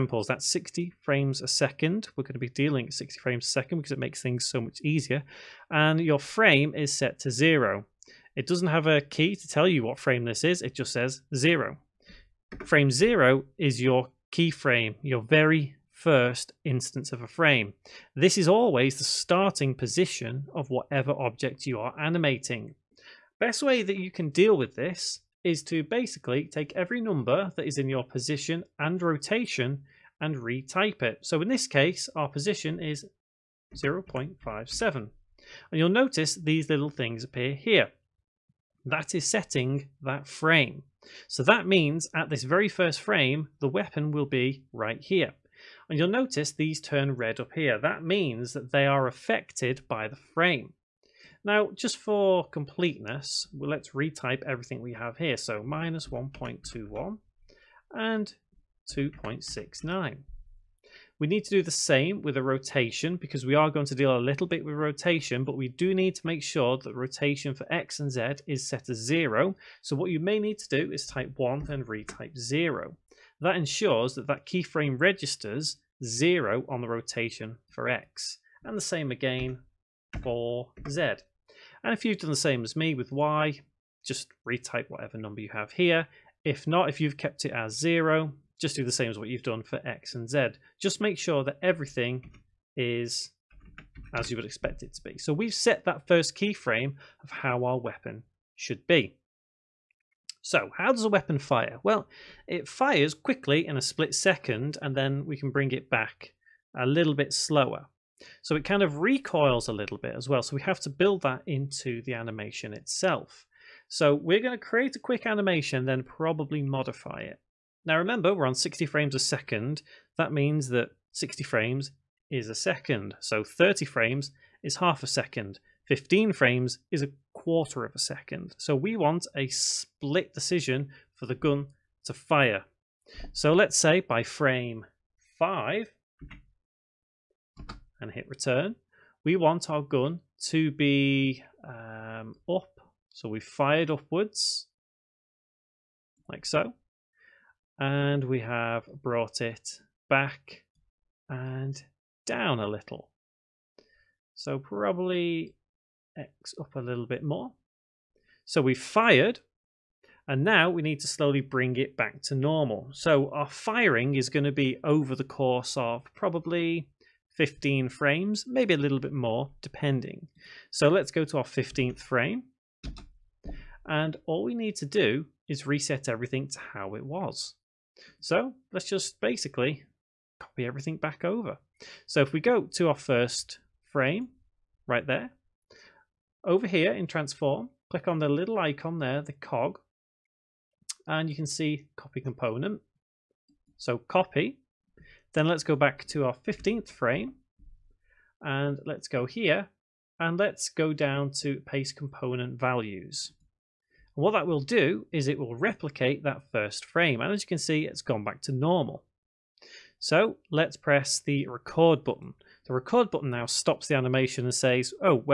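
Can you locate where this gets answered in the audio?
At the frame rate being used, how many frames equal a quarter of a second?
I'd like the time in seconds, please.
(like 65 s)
125 s.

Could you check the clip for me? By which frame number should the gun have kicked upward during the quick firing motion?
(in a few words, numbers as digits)
5.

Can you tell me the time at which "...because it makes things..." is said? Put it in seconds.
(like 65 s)
3 s.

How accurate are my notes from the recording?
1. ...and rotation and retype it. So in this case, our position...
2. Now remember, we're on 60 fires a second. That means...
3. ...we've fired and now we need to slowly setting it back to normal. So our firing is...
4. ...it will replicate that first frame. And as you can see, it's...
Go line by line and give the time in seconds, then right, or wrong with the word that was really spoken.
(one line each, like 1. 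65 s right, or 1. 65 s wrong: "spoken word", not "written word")
1. 28 s right
2. 117 s wrong: "frames", not "fires"
3. 158 s wrong: "bring", not "setting"
4. 205 s right.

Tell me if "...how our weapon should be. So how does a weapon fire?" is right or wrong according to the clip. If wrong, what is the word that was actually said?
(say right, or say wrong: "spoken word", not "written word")
right.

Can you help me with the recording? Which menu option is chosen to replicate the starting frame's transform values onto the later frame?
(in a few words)
paste component values.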